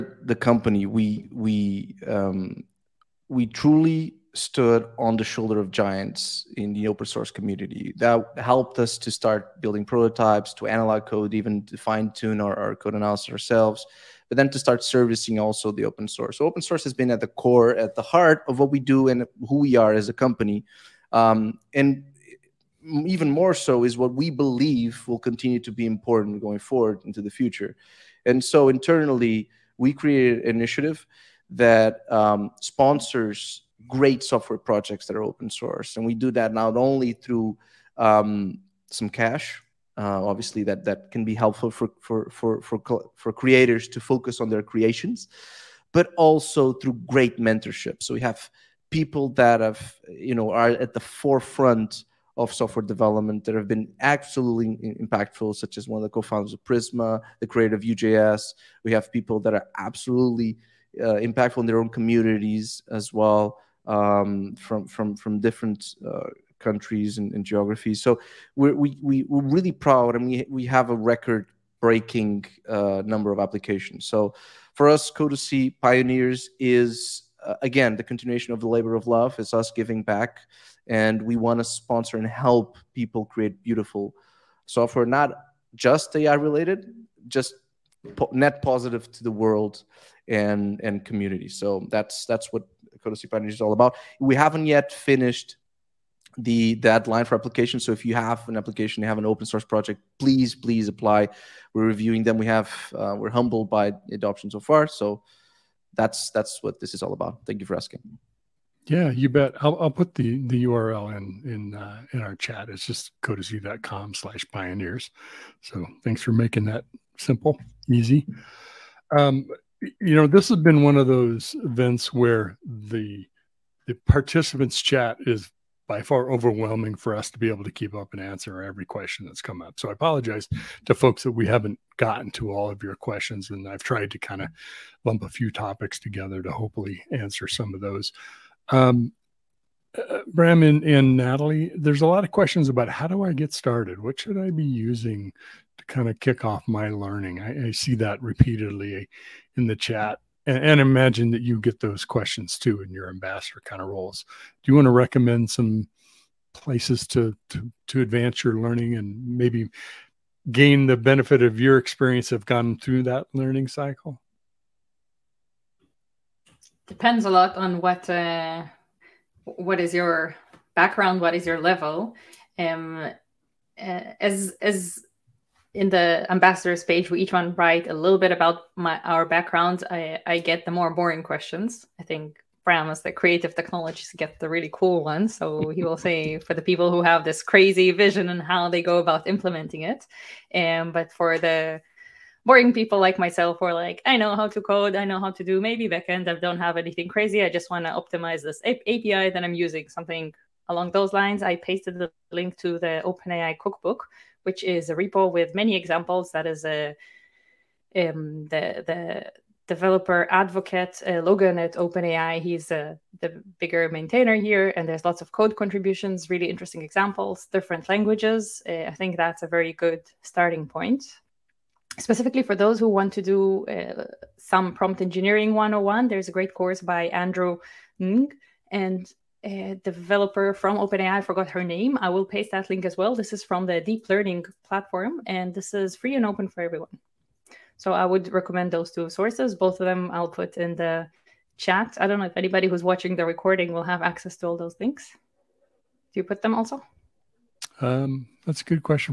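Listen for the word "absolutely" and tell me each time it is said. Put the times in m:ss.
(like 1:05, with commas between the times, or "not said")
0:53, 0:59.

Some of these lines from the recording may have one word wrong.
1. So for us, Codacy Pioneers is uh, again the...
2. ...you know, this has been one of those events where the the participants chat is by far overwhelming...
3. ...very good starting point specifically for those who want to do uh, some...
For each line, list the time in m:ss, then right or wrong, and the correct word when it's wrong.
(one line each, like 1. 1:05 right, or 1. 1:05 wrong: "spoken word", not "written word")
1. 1:14 right
2. 1:59 right
3. 3:39 right.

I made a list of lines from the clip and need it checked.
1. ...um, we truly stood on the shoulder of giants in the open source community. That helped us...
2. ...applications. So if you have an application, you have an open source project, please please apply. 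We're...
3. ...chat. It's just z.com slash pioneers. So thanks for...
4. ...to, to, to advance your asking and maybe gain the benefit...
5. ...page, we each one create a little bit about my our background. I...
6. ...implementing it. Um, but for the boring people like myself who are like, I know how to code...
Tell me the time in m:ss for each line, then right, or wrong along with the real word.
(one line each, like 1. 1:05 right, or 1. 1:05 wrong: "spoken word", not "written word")
1. 0:02 right
2. 1:37 right
3. 1:52 right
4. 2:37 wrong: "learning", not "asking"
5. 2:56 wrong: "write", not "create"
6. 3:09 right.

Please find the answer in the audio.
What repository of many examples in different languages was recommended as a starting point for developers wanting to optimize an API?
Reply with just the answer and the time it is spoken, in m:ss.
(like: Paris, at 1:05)
OpenAI cookbook, at 3:23.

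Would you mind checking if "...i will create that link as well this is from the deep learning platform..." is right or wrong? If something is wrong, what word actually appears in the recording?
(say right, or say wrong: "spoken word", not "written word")
wrong: "paste", not "create".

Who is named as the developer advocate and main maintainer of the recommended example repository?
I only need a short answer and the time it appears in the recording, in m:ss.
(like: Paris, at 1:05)
Logan, at 3:31.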